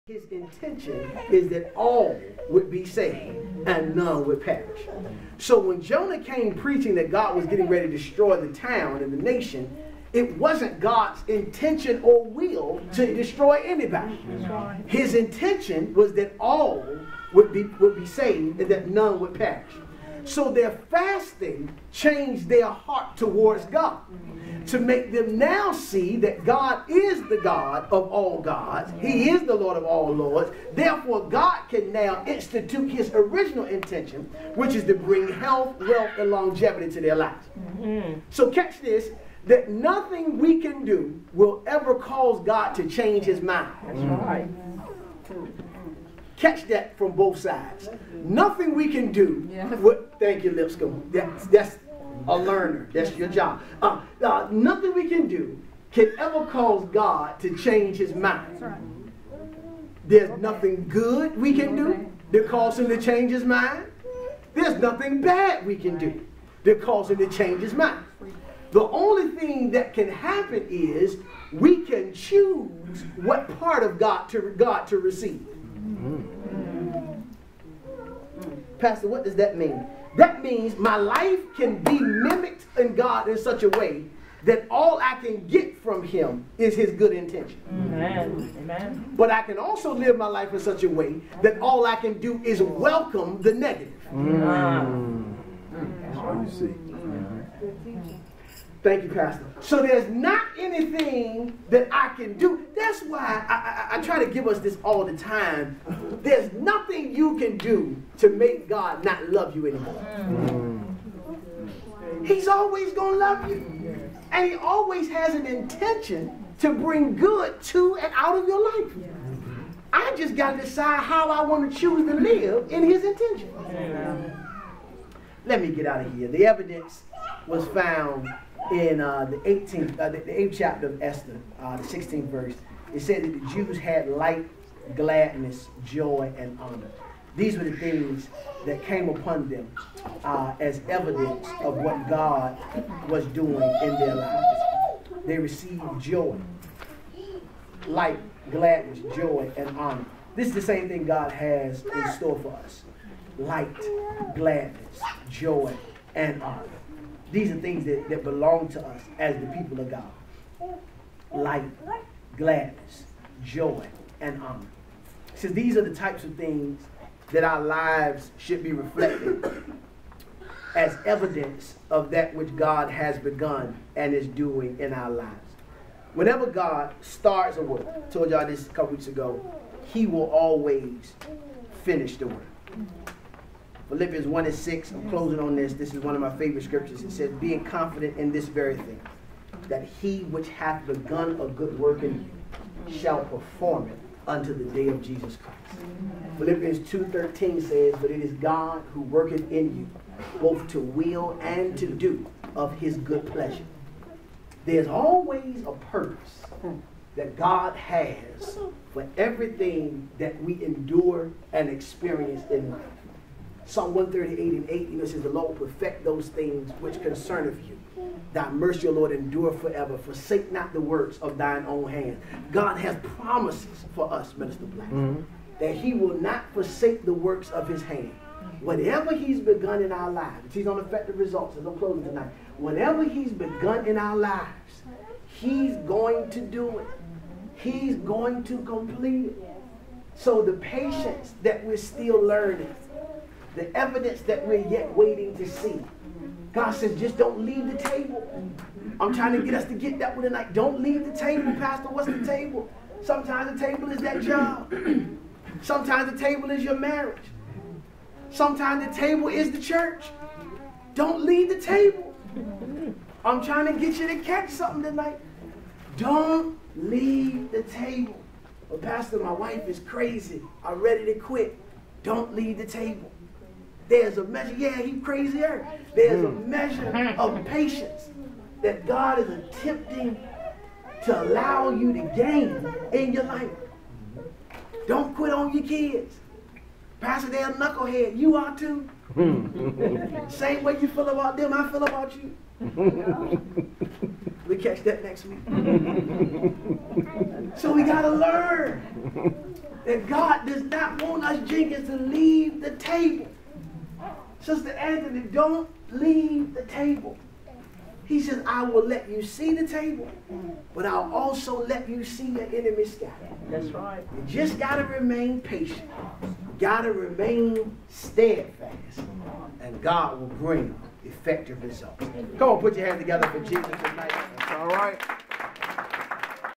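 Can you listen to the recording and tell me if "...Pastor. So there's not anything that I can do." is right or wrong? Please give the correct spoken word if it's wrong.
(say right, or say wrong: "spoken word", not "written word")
right.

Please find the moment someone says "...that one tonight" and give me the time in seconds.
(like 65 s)
249 s.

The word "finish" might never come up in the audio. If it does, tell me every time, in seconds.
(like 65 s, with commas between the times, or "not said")
181 s.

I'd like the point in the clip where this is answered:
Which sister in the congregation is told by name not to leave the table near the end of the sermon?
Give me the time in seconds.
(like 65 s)
304 s.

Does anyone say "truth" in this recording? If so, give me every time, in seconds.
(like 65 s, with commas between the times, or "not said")
not said.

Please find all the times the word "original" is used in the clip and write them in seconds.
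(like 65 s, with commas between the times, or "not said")
33 s.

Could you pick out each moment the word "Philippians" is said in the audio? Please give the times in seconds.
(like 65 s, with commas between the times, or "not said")
183 s, 196 s.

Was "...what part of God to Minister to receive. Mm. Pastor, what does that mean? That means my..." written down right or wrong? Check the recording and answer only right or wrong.
wrong.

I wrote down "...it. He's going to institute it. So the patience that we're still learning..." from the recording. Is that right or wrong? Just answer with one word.
wrong.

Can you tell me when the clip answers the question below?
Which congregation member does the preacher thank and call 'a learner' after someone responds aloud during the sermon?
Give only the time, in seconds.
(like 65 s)
50 s.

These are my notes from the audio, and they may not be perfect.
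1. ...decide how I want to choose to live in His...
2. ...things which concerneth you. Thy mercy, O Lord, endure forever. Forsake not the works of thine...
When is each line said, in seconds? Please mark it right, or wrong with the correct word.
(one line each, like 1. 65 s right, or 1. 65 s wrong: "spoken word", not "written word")
1. 120 s right
2. 216 s right.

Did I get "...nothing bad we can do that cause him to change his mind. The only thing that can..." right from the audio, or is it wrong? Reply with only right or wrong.
right.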